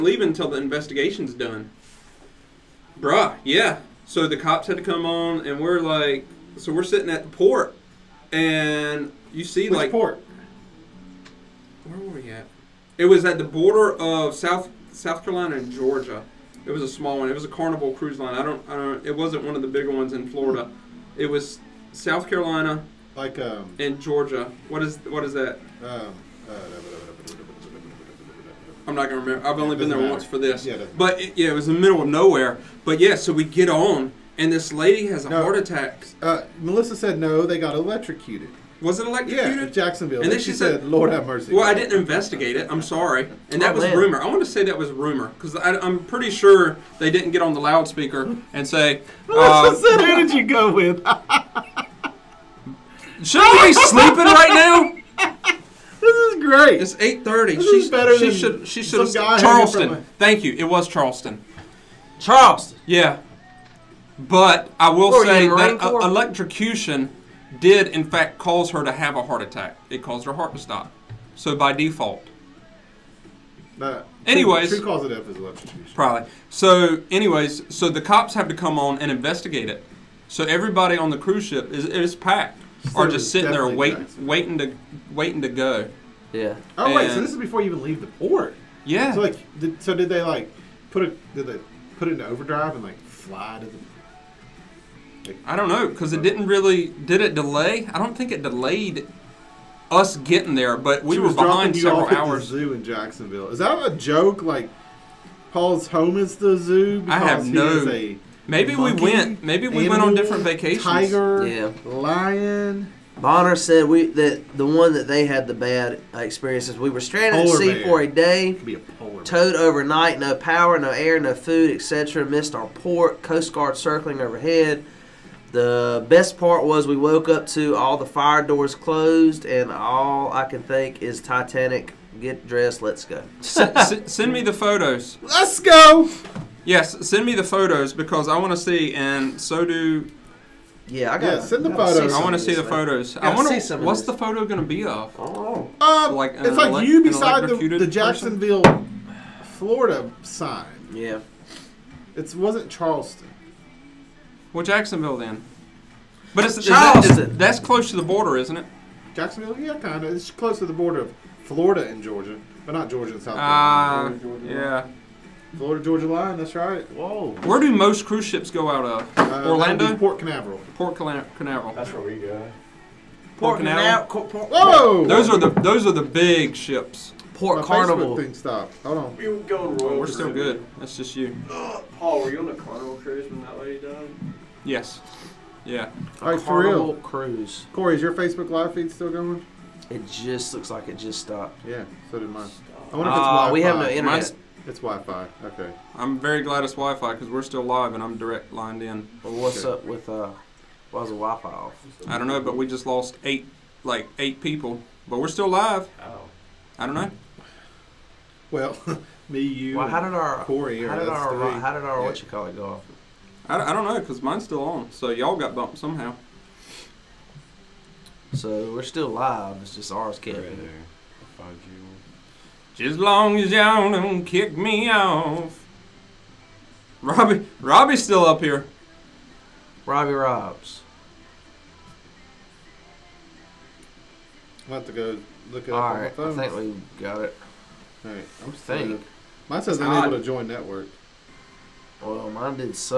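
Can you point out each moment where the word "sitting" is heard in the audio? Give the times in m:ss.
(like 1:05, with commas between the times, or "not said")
0:06, 1:23.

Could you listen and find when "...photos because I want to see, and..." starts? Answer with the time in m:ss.
2:17.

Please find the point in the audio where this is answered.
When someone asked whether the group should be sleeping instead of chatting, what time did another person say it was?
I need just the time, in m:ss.
0:56.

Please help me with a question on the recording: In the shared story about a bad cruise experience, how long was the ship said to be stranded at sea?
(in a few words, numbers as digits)
a day.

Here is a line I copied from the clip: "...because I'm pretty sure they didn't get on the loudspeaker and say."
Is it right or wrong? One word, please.
right.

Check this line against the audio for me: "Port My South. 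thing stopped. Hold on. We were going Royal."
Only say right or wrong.
wrong.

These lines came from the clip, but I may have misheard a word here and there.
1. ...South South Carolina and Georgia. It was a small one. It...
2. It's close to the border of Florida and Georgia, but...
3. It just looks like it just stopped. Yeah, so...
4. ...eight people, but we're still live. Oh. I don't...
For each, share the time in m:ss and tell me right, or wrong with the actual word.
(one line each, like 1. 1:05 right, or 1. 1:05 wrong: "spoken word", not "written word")
1. 0:14 right
2. 2:40 right
3. 3:09 right
4. 3:24 right.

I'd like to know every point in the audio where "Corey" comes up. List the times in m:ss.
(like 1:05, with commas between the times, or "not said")
3:07, 3:30.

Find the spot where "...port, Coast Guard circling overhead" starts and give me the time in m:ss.
2:02.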